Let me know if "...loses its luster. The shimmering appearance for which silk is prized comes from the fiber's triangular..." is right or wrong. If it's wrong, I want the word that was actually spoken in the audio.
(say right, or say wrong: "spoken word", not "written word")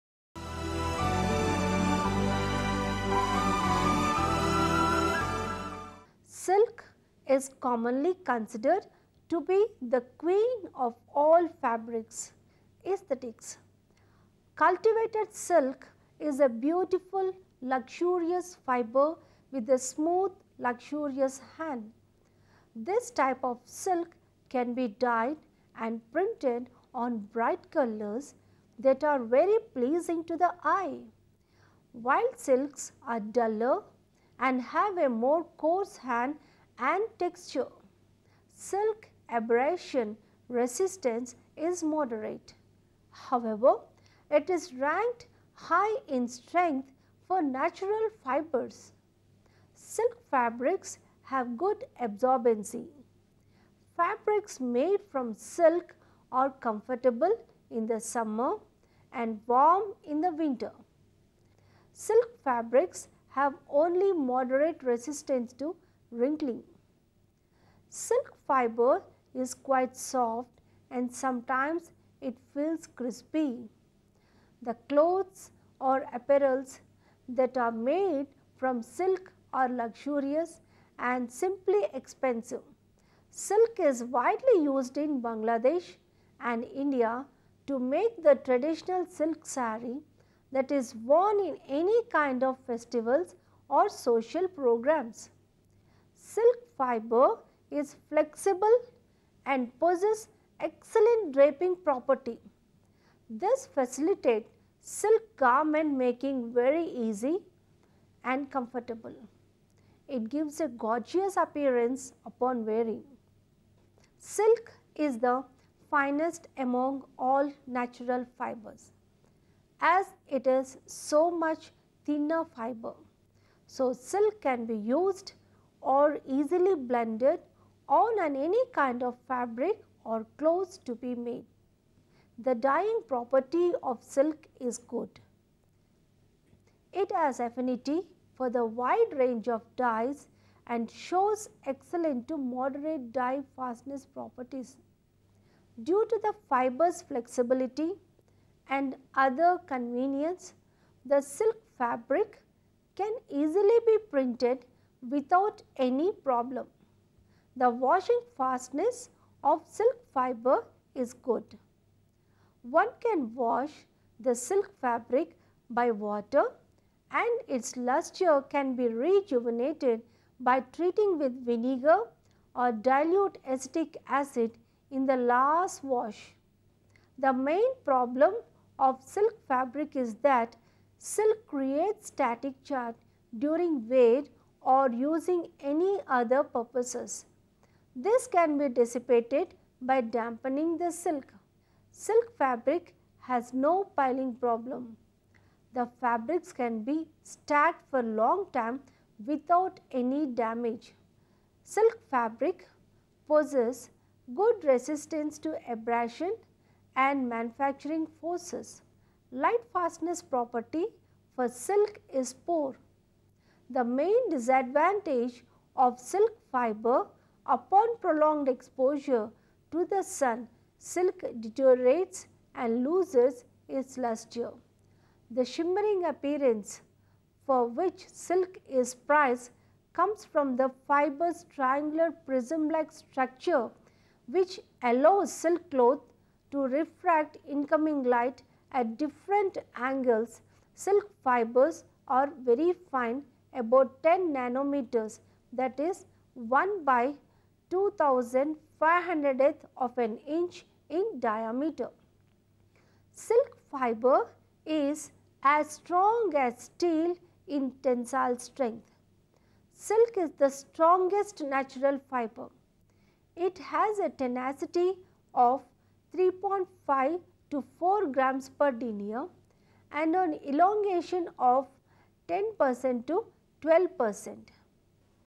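right.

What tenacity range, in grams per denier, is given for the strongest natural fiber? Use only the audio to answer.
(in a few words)
3.5 to 4.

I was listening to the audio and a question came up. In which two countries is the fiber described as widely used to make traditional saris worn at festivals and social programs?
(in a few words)
Bangladesh and India.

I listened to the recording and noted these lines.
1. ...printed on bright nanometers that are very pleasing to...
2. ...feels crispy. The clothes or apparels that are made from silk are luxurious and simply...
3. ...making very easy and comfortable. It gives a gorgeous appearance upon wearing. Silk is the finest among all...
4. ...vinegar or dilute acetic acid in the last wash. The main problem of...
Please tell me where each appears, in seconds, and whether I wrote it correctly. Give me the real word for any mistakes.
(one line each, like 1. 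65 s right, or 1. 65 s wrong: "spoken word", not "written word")
1. 26 s wrong: "colors", not "nanometers"
2. 72 s right
3. 106 s right
4. 171 s right.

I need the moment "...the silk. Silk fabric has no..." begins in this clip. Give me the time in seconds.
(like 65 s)
190 s.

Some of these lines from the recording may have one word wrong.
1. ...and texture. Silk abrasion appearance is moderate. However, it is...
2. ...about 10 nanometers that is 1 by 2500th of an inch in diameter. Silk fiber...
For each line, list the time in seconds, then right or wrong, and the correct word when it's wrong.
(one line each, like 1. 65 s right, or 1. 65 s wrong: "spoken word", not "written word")
1. 36 s wrong: "resistance", not "appearance"
2. 243 s right.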